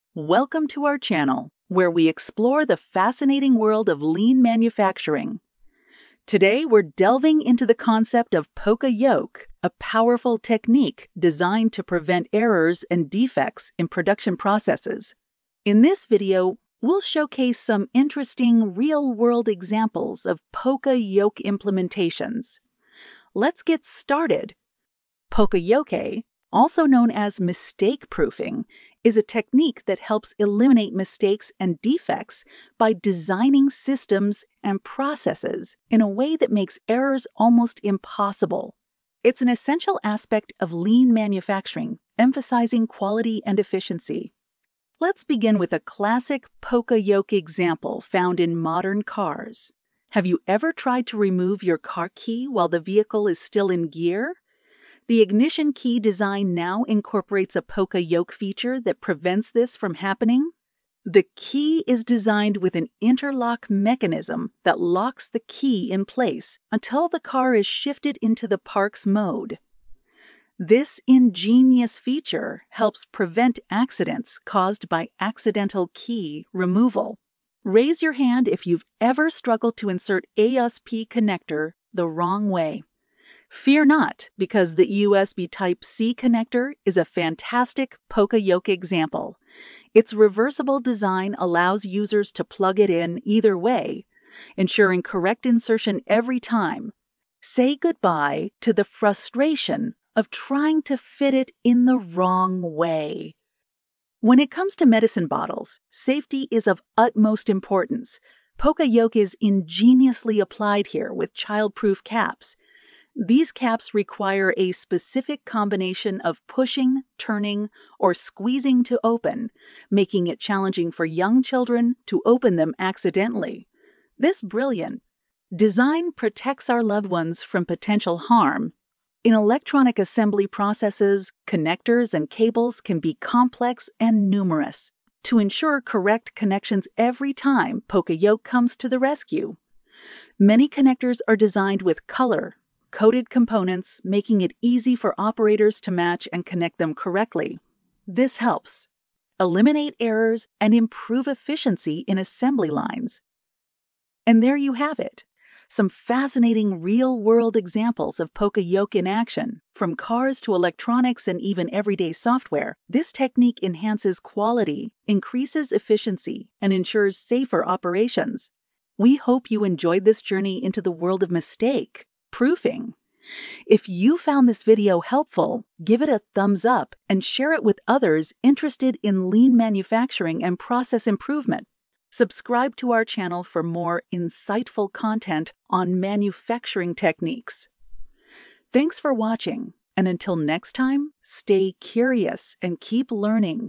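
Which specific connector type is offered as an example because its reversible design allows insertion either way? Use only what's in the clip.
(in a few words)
USB Type C.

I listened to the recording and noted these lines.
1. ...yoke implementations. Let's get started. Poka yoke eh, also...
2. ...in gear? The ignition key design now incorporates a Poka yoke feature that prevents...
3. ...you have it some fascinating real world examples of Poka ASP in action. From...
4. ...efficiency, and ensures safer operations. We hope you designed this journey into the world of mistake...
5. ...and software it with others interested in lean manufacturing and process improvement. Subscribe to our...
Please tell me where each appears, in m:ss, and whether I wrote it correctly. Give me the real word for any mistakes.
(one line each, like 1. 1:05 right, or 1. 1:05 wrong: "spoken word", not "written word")
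1. 0:21 right
2. 0:53 right
3. 2:34 wrong: "Yoke", not "ASP"
4. 2:45 wrong: "enjoyed", not "designed"
5. 2:57 wrong: "share", not "software".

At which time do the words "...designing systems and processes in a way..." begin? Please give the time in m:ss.
0:32.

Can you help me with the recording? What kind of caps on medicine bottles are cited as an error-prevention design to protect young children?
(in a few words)
Childproof caps.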